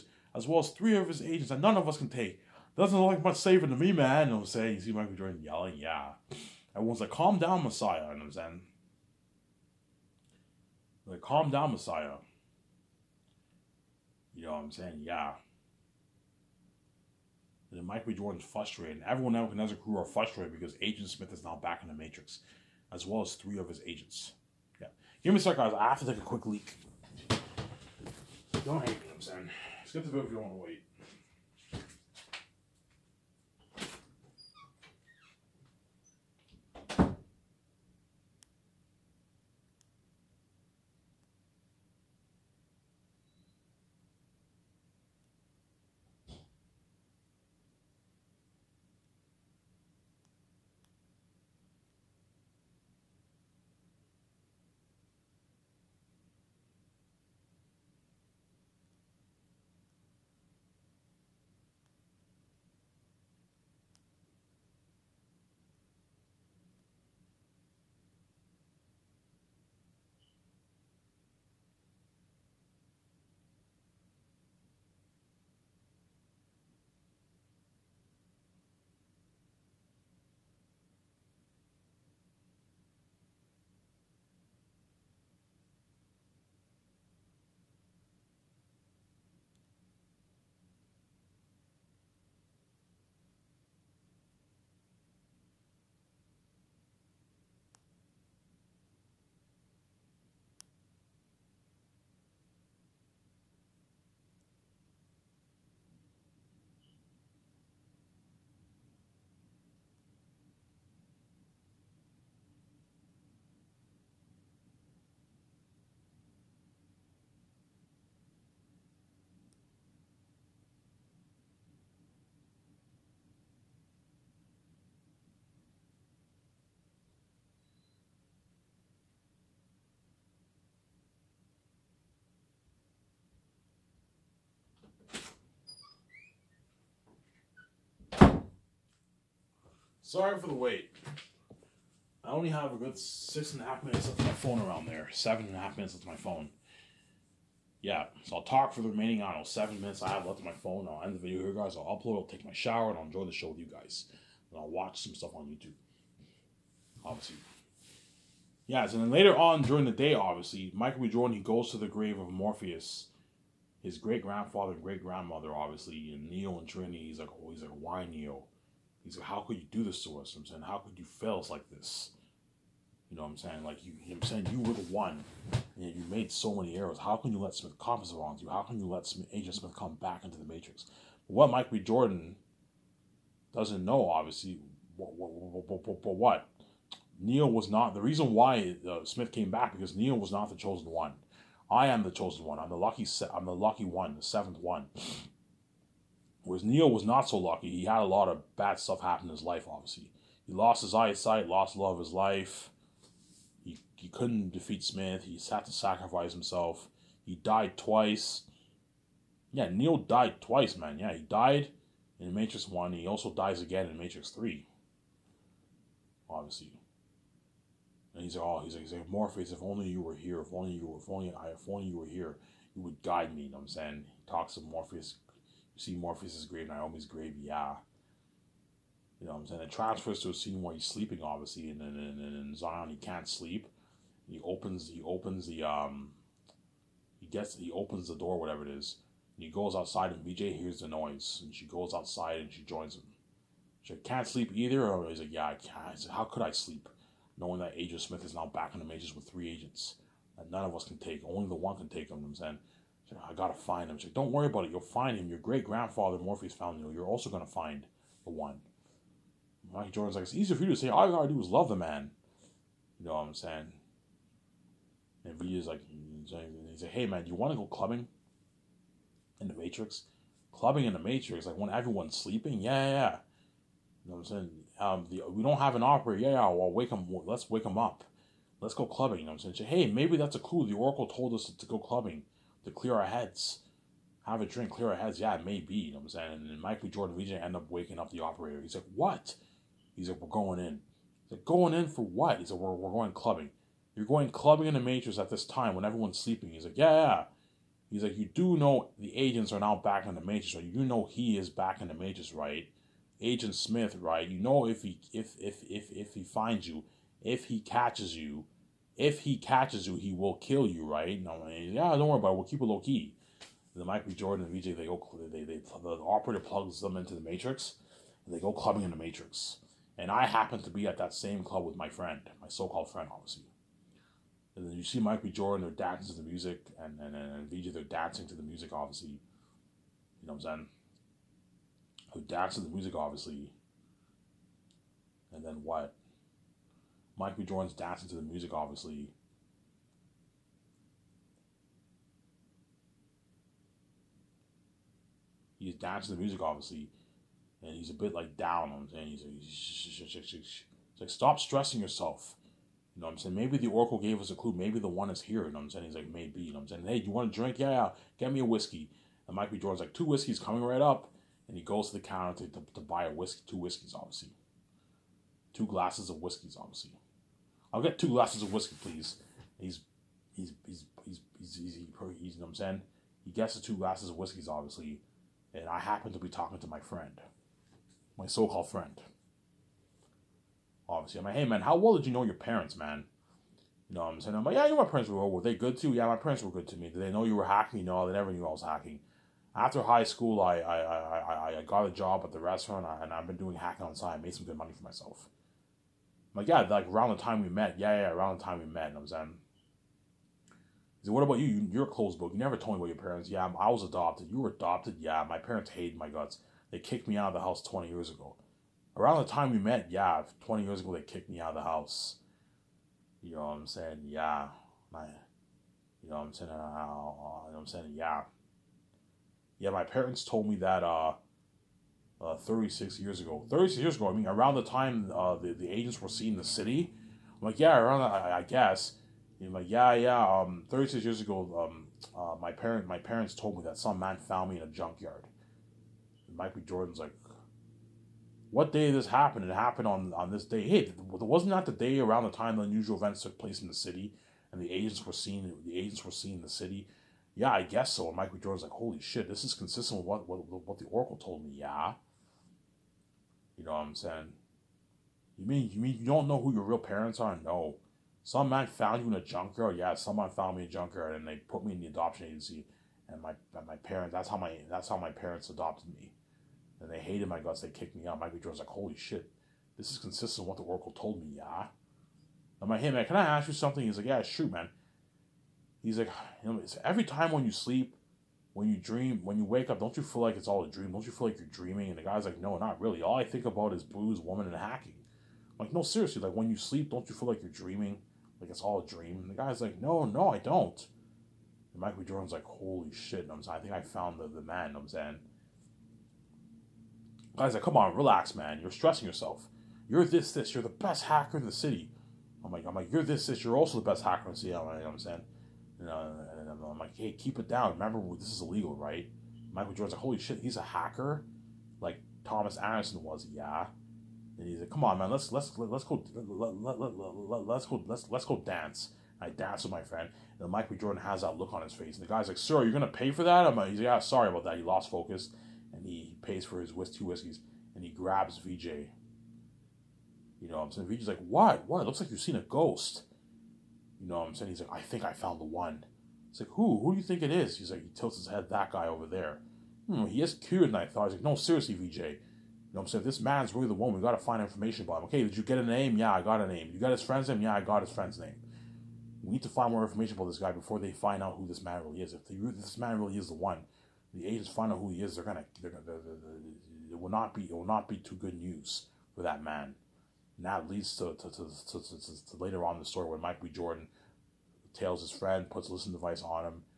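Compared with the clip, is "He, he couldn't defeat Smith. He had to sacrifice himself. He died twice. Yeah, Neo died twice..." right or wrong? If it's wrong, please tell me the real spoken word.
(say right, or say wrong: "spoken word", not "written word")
right.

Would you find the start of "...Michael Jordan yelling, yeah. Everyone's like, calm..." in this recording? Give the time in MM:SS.
00:04.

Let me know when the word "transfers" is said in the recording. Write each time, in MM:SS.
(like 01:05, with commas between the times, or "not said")
03:49.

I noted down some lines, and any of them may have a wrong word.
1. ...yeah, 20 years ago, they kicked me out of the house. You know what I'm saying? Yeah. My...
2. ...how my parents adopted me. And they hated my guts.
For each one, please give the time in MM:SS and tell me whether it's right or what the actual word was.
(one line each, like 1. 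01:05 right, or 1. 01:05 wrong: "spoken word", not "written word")
1. 06:49 right
2. 07:44 right.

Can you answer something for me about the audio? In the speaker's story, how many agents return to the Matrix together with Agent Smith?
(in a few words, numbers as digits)
3.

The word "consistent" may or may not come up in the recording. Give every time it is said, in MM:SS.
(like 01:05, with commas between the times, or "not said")
07:29, 07:49.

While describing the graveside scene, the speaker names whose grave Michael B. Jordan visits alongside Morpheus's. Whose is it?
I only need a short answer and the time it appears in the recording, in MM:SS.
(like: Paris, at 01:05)
Naomi, at 03:46.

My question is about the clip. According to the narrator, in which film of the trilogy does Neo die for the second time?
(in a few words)
Matrix 3.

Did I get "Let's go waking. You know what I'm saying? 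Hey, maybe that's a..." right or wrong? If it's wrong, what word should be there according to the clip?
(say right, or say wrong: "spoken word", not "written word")
wrong: "clubbing", not "waking".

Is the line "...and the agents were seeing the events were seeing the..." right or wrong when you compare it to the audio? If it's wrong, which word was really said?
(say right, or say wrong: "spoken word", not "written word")
wrong: "agents", not "events".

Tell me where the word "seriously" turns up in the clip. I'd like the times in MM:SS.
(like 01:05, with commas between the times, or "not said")
08:05, 09:01.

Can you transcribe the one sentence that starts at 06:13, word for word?
He gets the two glasses of whiskeys, obviously, and I happen to be talking to my friend, my so-called friend.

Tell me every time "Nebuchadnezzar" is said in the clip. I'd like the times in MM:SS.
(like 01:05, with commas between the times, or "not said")
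00:19.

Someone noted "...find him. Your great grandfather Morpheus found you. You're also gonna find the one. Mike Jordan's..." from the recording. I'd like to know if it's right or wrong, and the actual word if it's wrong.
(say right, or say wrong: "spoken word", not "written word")
right.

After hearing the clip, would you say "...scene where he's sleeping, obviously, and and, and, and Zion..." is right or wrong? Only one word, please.
right.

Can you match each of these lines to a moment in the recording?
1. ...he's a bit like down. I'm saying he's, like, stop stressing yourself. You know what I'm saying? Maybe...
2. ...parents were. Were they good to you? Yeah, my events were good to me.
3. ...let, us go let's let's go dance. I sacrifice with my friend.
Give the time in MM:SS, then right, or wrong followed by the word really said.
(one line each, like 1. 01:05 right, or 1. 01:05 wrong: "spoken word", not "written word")
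1. 05:47 right
2. 06:24 wrong: "parents", not "events"
3. 08:36 wrong: "dance", not "sacrifice".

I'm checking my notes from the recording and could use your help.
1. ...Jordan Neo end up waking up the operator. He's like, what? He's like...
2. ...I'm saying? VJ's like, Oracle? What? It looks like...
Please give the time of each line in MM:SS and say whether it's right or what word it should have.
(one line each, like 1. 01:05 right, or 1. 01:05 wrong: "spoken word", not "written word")
1. 04:46 wrong: "Legion", not "Neo"
2. 08:50 wrong: "What", not "Oracle".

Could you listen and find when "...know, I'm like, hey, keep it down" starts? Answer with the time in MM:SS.
08:25.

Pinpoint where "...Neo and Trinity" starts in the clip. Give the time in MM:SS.
02:46.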